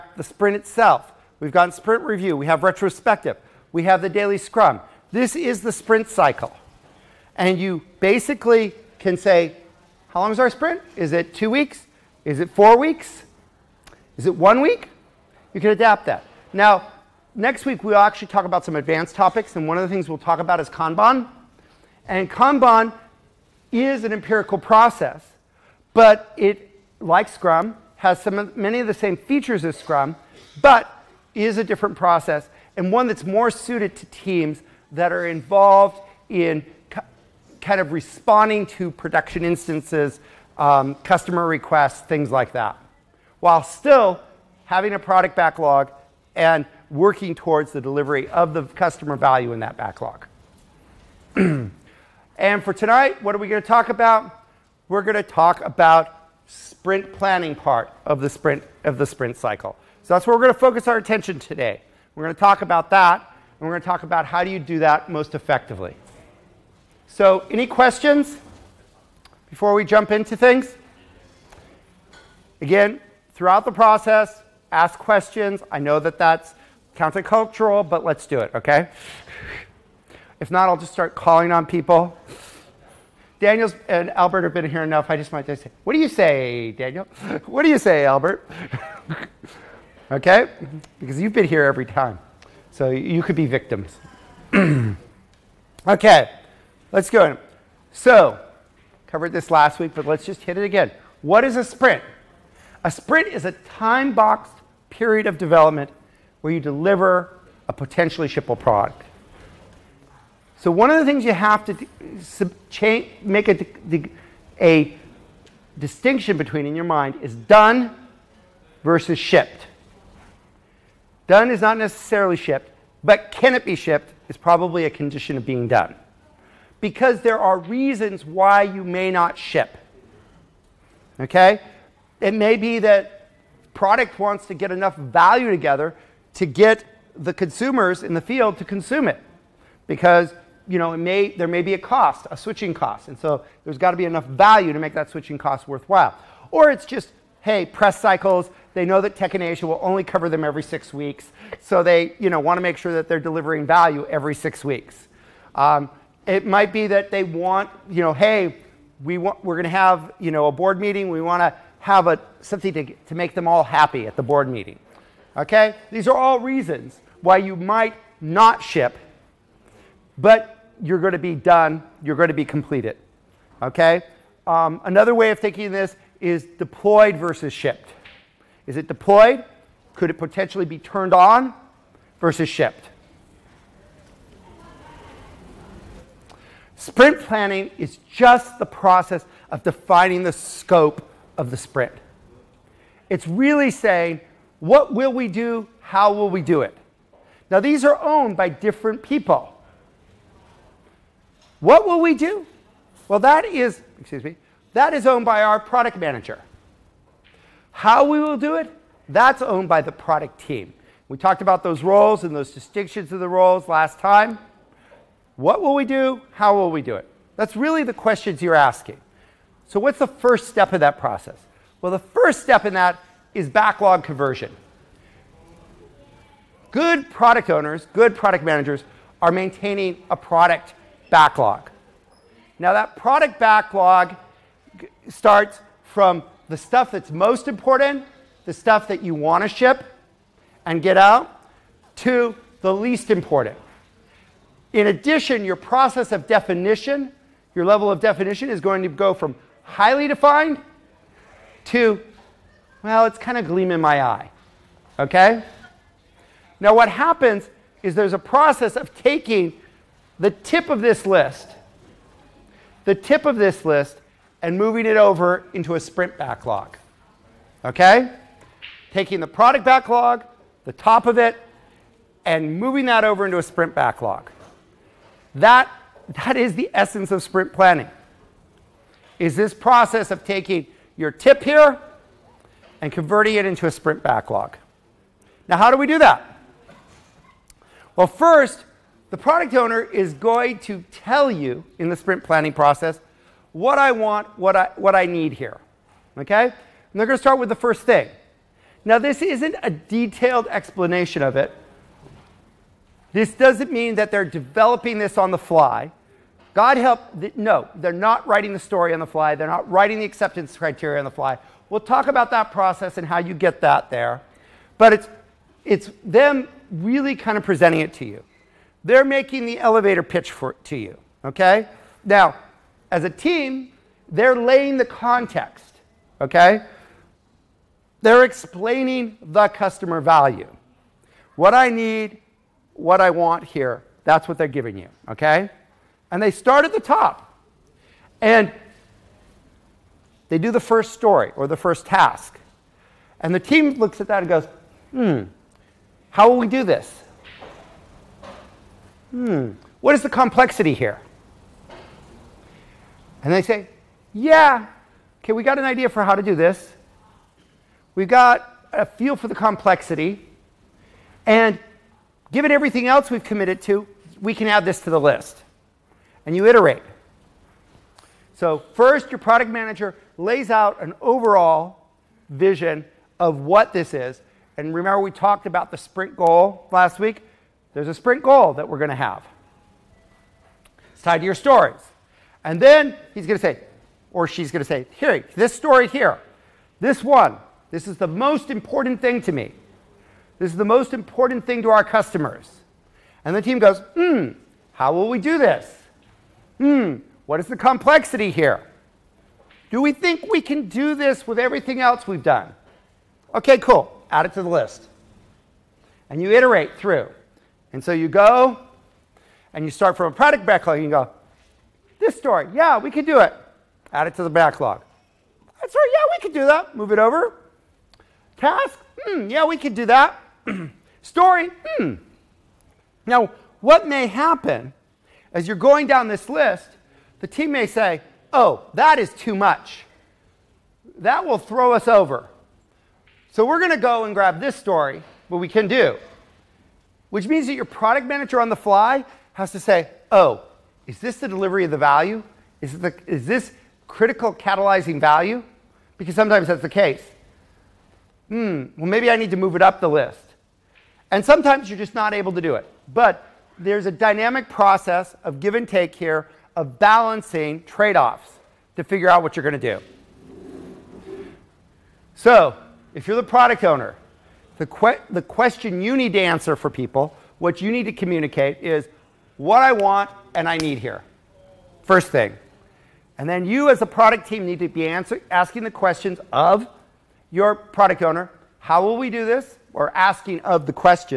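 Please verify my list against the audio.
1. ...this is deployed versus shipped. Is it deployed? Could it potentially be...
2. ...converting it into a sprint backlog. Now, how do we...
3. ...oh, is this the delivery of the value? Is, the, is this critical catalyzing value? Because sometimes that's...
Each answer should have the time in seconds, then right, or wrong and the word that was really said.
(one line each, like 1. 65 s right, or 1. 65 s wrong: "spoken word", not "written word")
1. 175 s right
2. 282 s right
3. 440 s right.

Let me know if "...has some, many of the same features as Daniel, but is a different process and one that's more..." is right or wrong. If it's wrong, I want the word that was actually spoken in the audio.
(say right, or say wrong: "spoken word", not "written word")
wrong: "Scrum", not "Daniel".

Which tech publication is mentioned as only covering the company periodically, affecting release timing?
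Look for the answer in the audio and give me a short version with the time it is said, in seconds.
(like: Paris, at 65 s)
Tech in Asia, at 149 s.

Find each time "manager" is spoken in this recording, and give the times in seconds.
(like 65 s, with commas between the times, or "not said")
205 s, 228 s, 369 s, 438 s.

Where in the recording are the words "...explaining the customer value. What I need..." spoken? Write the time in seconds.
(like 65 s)
328 s.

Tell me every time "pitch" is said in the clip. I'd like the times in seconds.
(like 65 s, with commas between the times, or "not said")
320 s.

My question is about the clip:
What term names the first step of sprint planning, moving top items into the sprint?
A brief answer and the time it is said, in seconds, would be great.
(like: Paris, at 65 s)
backlog conversion, at 223 s.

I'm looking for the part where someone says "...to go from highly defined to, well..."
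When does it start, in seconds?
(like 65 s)
248 s.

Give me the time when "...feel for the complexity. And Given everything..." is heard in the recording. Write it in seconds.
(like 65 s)
358 s.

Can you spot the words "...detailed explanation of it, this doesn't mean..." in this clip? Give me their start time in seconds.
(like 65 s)
299 s.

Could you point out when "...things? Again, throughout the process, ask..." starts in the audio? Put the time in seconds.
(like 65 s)
70 s.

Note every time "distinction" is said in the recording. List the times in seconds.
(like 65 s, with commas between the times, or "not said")
115 s, 212 s.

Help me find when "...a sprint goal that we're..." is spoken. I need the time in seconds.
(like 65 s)
377 s.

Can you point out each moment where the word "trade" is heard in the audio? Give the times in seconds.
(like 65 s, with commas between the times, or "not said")
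457 s.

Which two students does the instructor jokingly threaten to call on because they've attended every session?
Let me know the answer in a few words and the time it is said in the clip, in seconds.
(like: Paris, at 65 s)
Daniel and Albert, at 83 s.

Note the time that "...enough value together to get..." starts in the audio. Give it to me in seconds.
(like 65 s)
134 s.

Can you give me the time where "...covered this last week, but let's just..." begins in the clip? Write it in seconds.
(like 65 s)
99 s.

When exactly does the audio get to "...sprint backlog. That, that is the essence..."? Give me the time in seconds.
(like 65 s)
273 s.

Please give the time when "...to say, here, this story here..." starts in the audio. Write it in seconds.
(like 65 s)
384 s.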